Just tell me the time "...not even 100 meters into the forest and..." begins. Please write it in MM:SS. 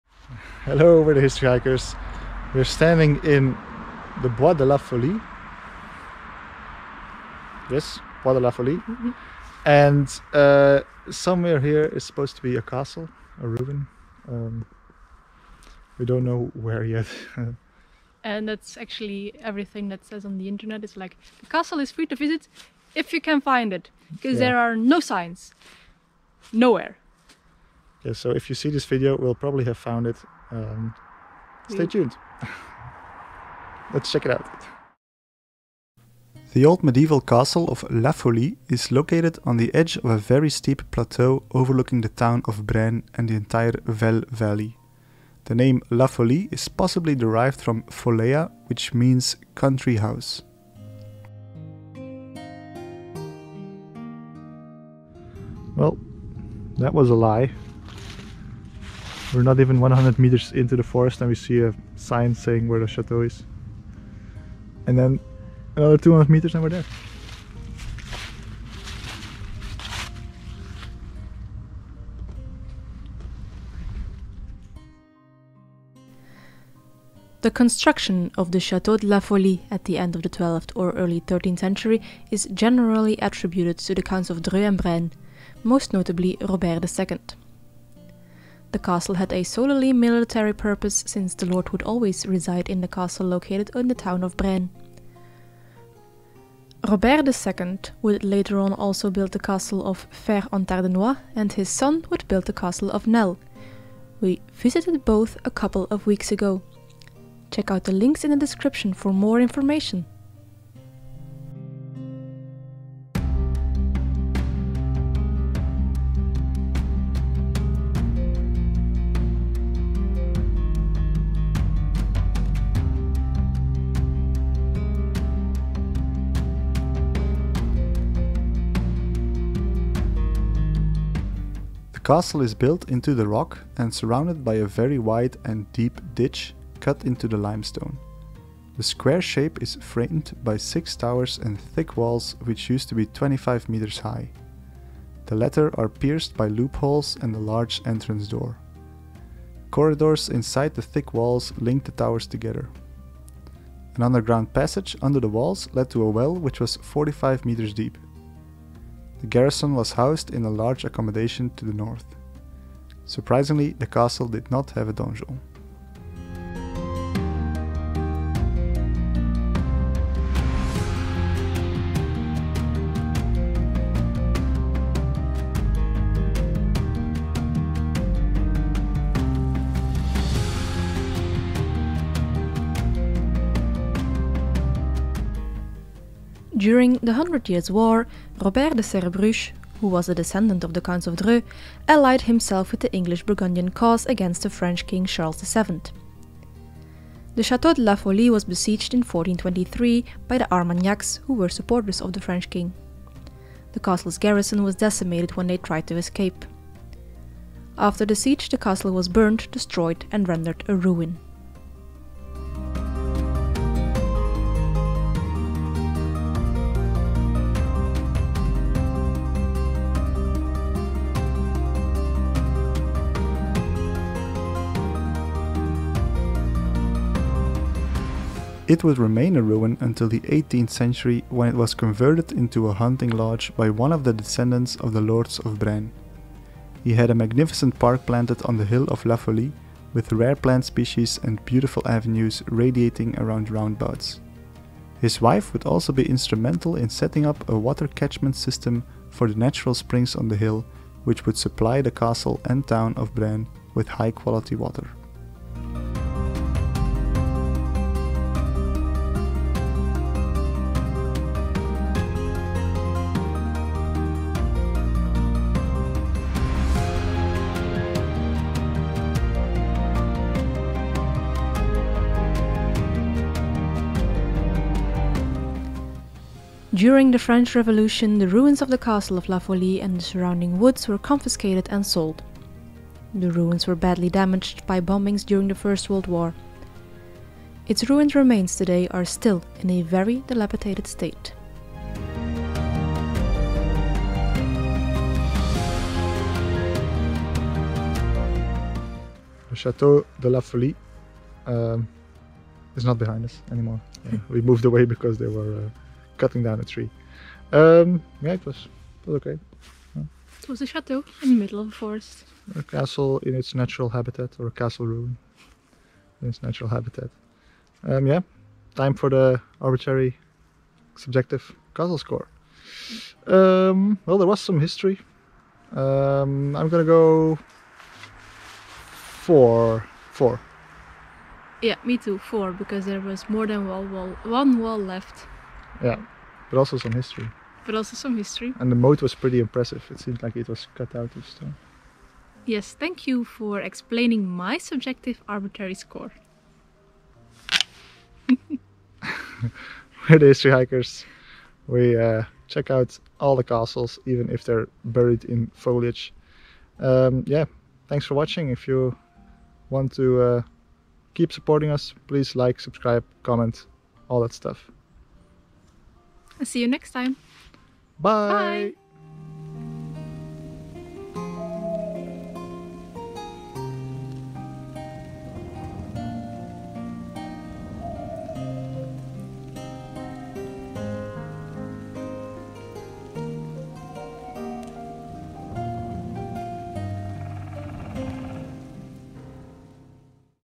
00:59.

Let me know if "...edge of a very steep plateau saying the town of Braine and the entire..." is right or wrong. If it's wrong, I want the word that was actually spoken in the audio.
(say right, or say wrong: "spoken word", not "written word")
wrong: "overlooking", not "saying".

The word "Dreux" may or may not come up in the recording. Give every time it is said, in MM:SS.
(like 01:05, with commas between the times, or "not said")
01:24, 03:11.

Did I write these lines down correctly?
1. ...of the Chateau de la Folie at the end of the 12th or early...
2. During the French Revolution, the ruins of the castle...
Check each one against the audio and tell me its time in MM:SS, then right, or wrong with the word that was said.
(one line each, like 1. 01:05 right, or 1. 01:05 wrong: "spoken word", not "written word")
1. 01:18 right
2. 04:36 right.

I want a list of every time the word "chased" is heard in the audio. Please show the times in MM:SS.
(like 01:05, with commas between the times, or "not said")
not said.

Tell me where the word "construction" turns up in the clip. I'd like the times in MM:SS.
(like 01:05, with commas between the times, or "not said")
01:17.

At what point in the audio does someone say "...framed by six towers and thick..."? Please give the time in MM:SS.
02:19.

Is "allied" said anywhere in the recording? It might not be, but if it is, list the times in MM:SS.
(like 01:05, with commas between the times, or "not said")
03:11.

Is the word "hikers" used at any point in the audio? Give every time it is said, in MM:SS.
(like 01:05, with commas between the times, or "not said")
00:01, 05:50.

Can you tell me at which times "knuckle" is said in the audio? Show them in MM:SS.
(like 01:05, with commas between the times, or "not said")
not said.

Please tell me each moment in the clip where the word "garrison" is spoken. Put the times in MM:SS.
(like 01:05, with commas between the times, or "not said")
02:39, 03:24.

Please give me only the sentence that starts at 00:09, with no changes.
And uh, somewhere here is supposed to be a castle, a ruin.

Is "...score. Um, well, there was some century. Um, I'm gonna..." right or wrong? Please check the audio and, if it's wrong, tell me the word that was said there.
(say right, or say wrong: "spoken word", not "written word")
wrong: "history", not "century".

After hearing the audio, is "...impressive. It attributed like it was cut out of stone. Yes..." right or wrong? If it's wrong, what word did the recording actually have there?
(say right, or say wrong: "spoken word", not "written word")
wrong: "seemed", not "attributed".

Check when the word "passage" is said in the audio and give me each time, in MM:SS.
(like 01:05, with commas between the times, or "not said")
02:34.